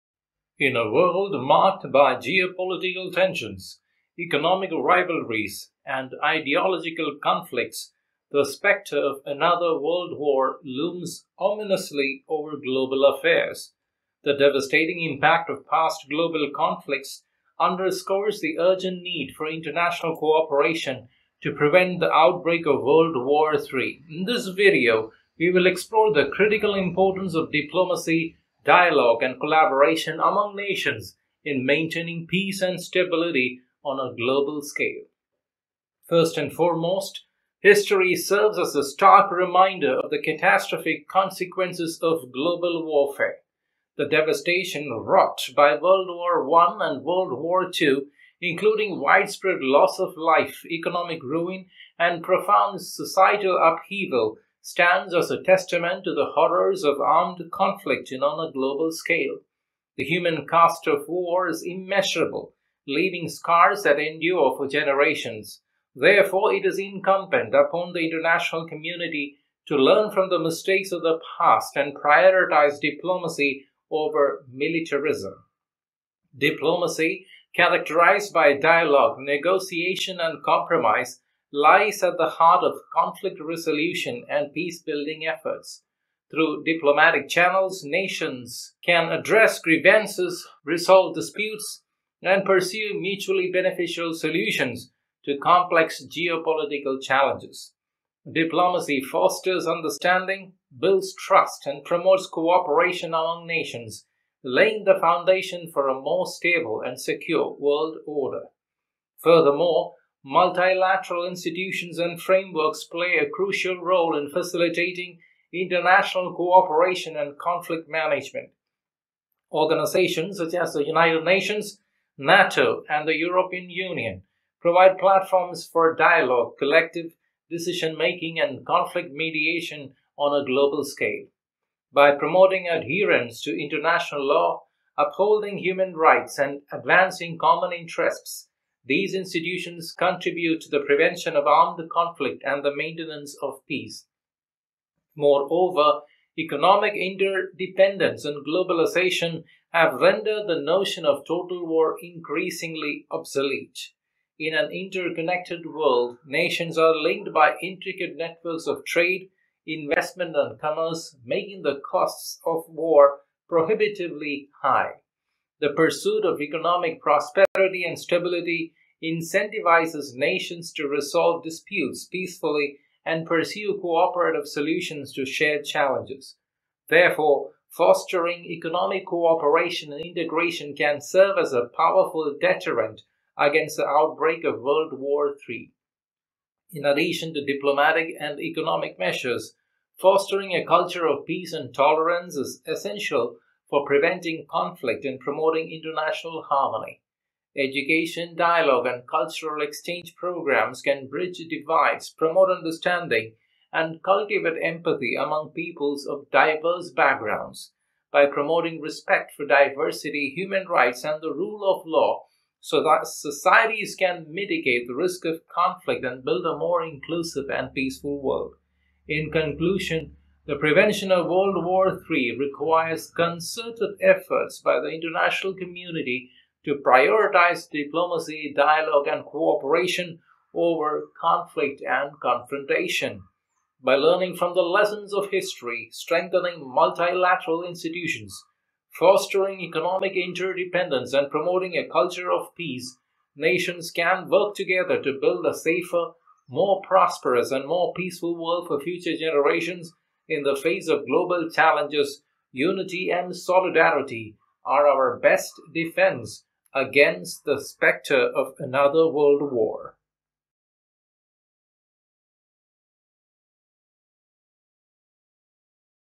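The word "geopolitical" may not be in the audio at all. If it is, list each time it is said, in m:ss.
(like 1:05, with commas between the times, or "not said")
0:02, 1:36.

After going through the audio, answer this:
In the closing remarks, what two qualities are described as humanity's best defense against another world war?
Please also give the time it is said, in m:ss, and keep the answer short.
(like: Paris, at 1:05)
unity and solidarity, at 4:12.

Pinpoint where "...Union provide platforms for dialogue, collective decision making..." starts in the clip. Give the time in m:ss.
2:03.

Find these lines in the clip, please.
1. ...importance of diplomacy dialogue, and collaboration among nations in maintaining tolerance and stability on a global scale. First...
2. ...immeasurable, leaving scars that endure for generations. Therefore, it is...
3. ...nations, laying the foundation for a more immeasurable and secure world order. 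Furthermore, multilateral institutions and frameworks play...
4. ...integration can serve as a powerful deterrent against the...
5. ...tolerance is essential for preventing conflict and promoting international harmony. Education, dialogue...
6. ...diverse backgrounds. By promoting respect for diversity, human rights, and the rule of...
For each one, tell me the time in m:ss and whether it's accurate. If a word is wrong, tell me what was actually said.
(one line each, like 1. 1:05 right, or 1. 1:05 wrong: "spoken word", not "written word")
1. 0:26 wrong: "peace", not "tolerance"
2. 1:01 right
3. 1:43 wrong: "stable", not "immeasurable"
4. 3:00 right
5. 3:11 right
6. 3:26 right.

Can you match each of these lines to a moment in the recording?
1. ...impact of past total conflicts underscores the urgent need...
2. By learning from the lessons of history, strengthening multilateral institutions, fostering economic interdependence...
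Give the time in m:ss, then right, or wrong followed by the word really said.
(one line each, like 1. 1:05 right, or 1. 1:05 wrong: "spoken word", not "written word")
1. 0:15 wrong: "global", not "total"
2. 3:53 right.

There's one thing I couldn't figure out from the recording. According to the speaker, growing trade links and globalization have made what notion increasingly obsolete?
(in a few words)
total war.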